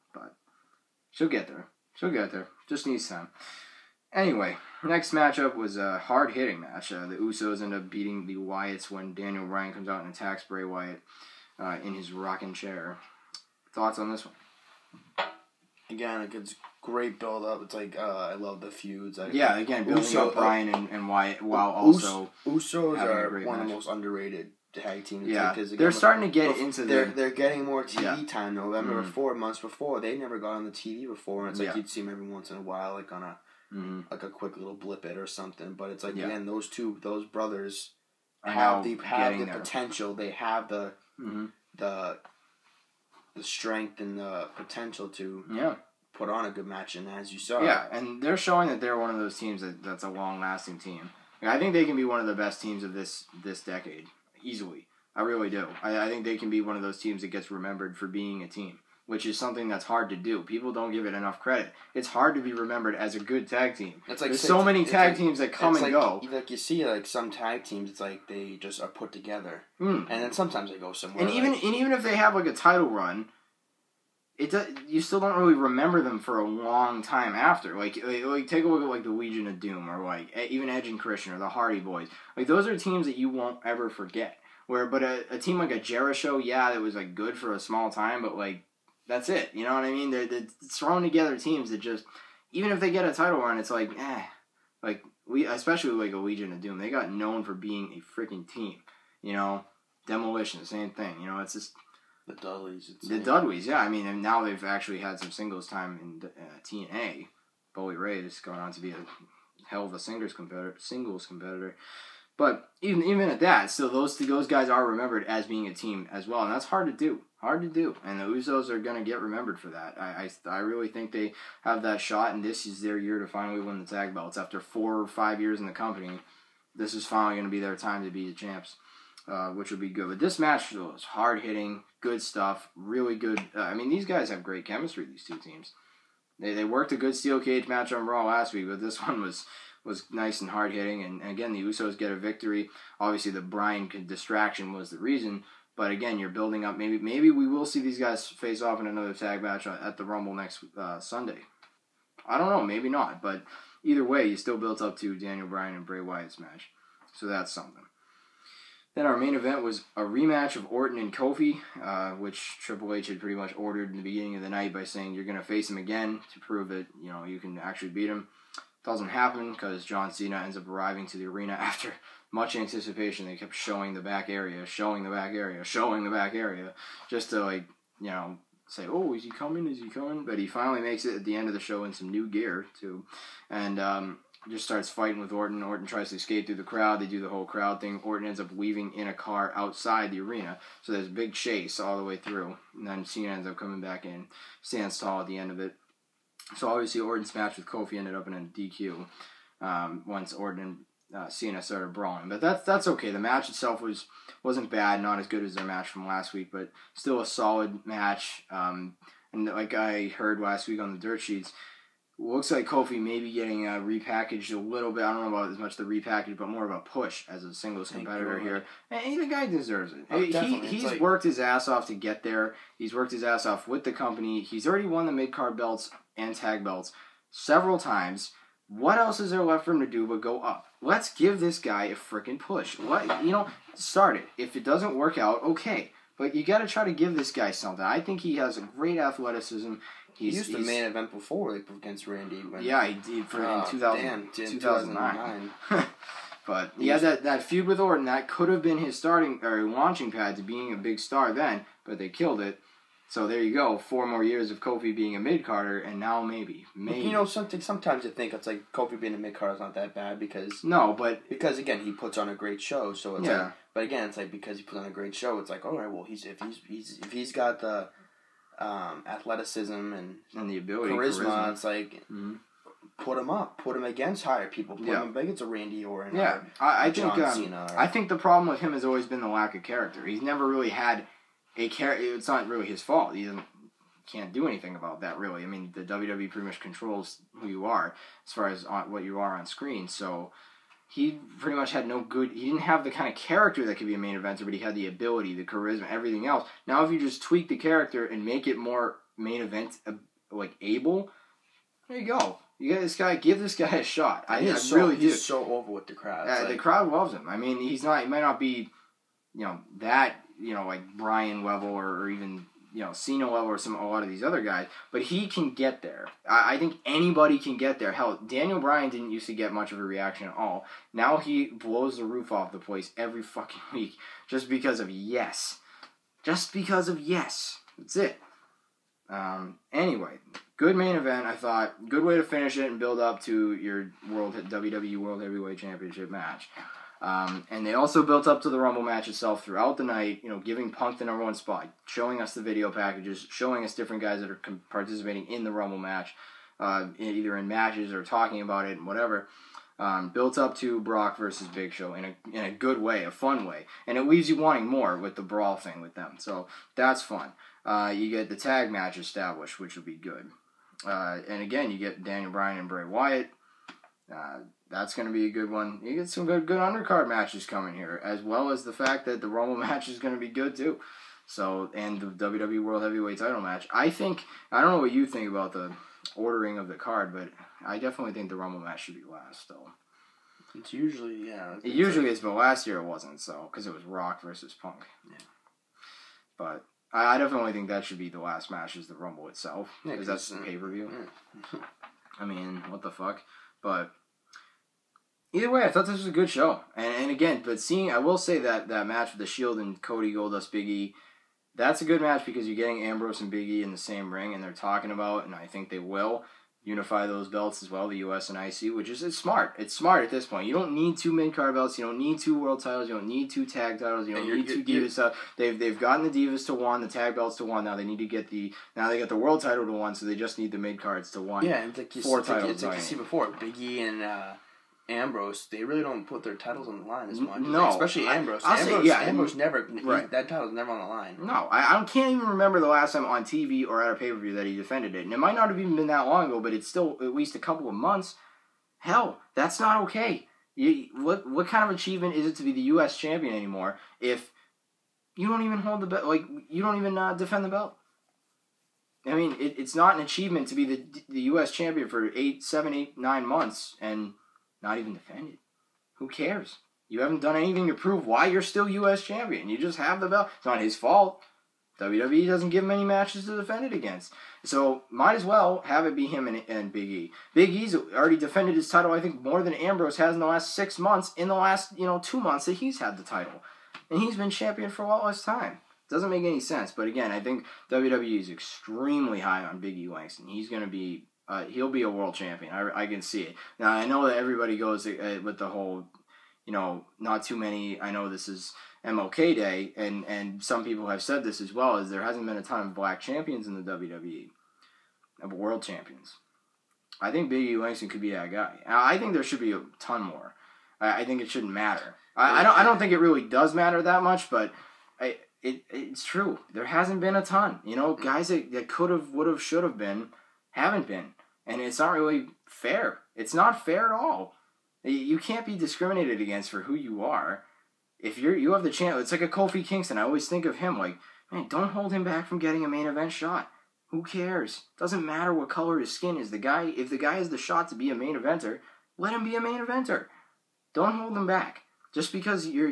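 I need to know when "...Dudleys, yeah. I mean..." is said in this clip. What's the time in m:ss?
1:43.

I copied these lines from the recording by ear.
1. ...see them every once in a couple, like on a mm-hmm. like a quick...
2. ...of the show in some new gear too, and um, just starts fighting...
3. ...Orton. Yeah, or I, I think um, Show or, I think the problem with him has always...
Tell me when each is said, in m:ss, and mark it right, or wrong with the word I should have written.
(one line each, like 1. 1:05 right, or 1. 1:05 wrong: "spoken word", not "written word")
1. 0:31 wrong: "while", not "couple"
2. 3:01 right
3. 4:35 wrong: "Cena", not "Show".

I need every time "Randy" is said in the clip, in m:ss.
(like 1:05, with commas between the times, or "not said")
4:02, 4:35.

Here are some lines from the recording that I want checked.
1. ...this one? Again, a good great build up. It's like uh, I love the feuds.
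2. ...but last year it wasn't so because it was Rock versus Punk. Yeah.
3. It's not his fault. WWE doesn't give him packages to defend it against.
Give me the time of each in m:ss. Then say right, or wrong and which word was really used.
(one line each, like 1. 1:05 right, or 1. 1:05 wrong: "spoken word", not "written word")
1. 0:14 right
2. 6:22 right
3. 7:40 wrong: "matches", not "packages".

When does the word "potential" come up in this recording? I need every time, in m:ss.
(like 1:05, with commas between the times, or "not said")
0:39, 0:44.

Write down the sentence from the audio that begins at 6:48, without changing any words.
and IC, which is it's smart.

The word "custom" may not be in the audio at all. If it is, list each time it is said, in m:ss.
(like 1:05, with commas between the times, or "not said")
not said.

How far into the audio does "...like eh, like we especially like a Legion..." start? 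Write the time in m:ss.
1:33.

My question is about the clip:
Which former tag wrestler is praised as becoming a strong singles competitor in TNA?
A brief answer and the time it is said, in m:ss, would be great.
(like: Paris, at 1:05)
Bully Ray, at 1:47.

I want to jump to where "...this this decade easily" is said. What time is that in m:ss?
0:52.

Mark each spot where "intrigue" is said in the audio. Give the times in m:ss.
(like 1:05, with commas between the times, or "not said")
not said.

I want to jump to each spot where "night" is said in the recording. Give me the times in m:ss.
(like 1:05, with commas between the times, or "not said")
2:44, 5:39.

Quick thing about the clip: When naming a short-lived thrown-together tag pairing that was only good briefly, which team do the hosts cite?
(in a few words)
Jeri-Show.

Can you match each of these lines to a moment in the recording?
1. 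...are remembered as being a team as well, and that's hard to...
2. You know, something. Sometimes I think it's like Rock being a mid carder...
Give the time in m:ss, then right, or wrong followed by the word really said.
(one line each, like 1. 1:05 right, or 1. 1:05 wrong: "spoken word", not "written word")
1. 1:54 right
2. 4:17 wrong: "Kofi", not "Rock".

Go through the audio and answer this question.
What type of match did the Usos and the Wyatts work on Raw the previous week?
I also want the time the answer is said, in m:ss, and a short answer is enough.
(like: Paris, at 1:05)
Steel cage match, at 2:17.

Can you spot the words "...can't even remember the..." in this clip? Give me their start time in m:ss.
7:11.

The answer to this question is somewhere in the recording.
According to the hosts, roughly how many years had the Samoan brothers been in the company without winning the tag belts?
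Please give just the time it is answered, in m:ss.
2:04.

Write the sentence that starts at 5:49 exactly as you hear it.
Um, built up to Brock versus Big Show in a, in a good way, a fun way.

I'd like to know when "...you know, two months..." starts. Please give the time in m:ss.
7:51.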